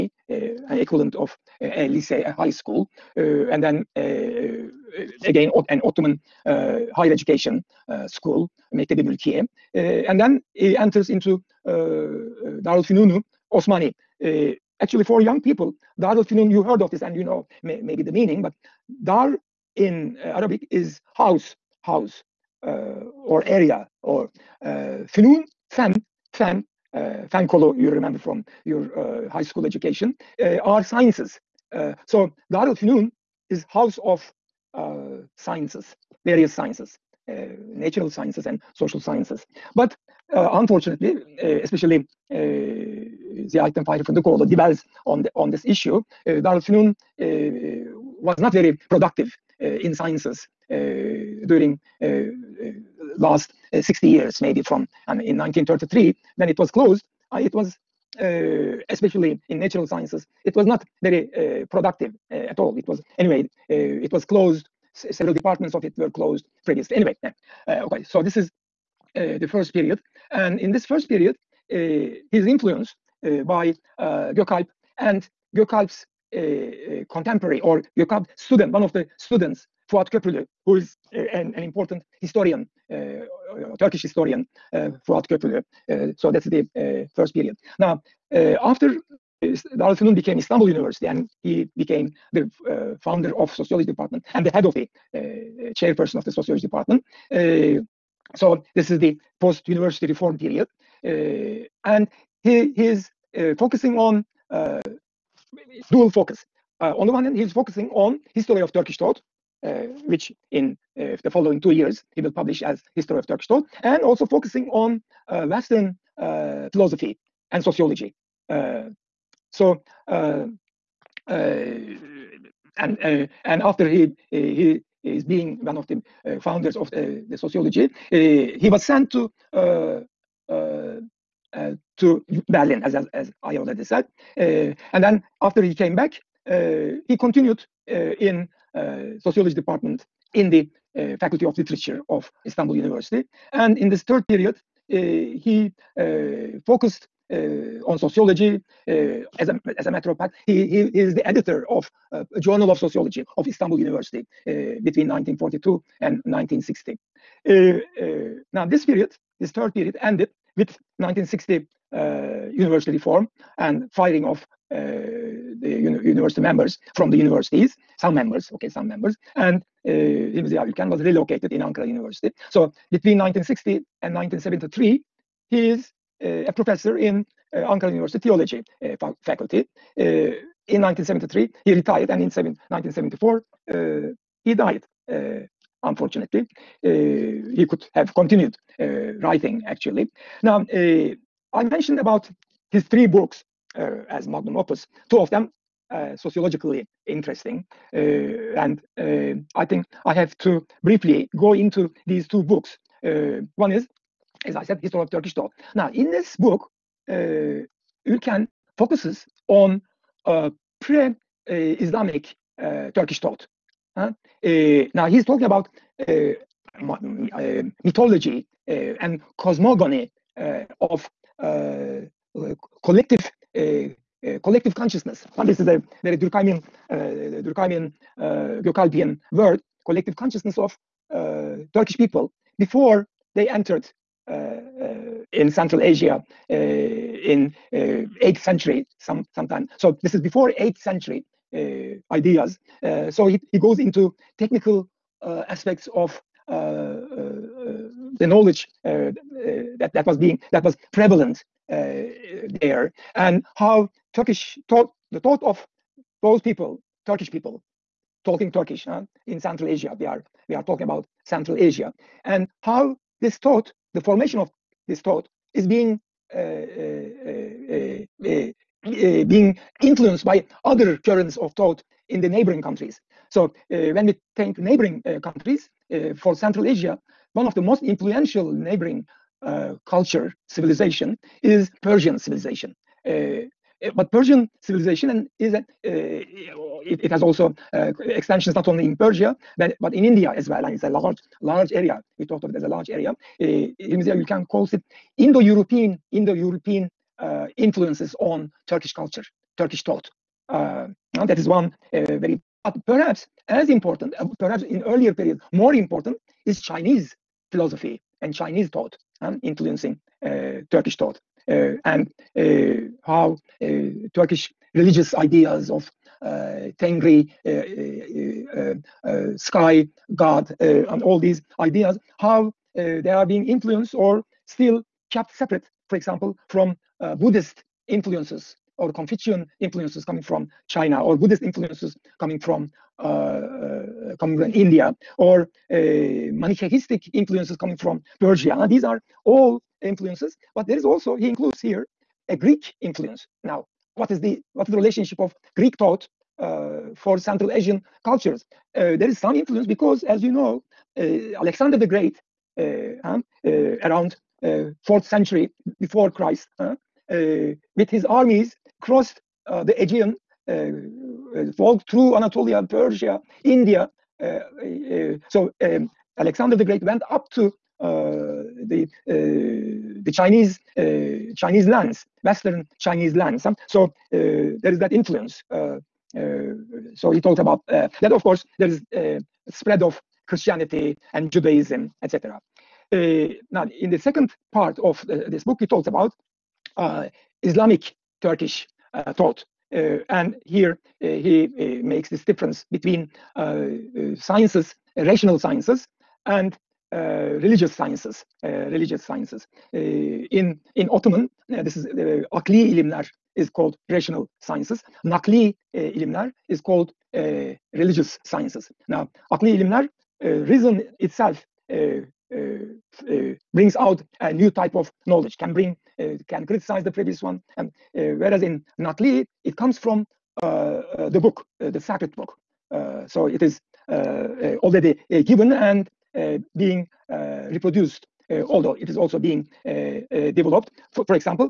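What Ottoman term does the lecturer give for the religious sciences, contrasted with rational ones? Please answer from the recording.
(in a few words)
Nakli ilimler.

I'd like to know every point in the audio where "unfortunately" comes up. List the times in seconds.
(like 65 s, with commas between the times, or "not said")
40 s, 185 s.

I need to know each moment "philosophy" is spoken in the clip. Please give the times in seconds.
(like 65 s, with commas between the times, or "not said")
116 s, 307 s.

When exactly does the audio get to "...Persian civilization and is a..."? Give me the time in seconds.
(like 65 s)
284 s.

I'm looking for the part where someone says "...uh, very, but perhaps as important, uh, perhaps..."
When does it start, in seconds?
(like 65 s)
301 s.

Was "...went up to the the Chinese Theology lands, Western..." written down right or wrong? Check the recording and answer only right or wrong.
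wrong.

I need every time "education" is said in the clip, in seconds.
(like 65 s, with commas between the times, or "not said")
7 s, 29 s.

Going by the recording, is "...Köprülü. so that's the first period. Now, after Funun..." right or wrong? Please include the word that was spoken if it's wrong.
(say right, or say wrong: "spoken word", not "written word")
wrong: "Darülfünun", not "Funun".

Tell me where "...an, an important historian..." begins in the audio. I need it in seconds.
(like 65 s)
81 s.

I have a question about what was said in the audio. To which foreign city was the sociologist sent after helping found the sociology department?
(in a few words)
Berlin.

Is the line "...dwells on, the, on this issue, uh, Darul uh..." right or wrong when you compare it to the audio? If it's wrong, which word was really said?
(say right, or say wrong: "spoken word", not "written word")
right.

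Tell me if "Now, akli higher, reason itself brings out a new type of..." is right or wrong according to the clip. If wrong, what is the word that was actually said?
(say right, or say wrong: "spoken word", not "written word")
wrong: "ilimler", not "higher".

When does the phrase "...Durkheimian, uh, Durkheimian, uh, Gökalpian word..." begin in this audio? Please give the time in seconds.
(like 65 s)
226 s.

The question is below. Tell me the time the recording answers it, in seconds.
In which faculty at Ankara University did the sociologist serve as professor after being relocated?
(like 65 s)
178 s.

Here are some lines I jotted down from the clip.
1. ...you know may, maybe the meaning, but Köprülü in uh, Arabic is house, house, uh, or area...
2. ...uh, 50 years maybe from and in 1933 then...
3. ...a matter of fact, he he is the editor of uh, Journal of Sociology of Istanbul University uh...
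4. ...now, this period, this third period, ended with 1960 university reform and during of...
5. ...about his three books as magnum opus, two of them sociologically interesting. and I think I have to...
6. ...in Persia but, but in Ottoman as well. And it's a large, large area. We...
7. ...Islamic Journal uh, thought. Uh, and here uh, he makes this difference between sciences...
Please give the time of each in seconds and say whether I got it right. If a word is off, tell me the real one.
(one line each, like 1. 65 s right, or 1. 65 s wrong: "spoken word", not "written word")
1. 17 s wrong: "Dar", not "Köprülü"
2. 53 s wrong: "60", not "50"
3. 149 s right
4. 158 s wrong: "firing", not "during"
5. 191 s right
6. 288 s wrong: "India", not "Ottoman"
7. 387 s wrong: "Turkish", not "Journal".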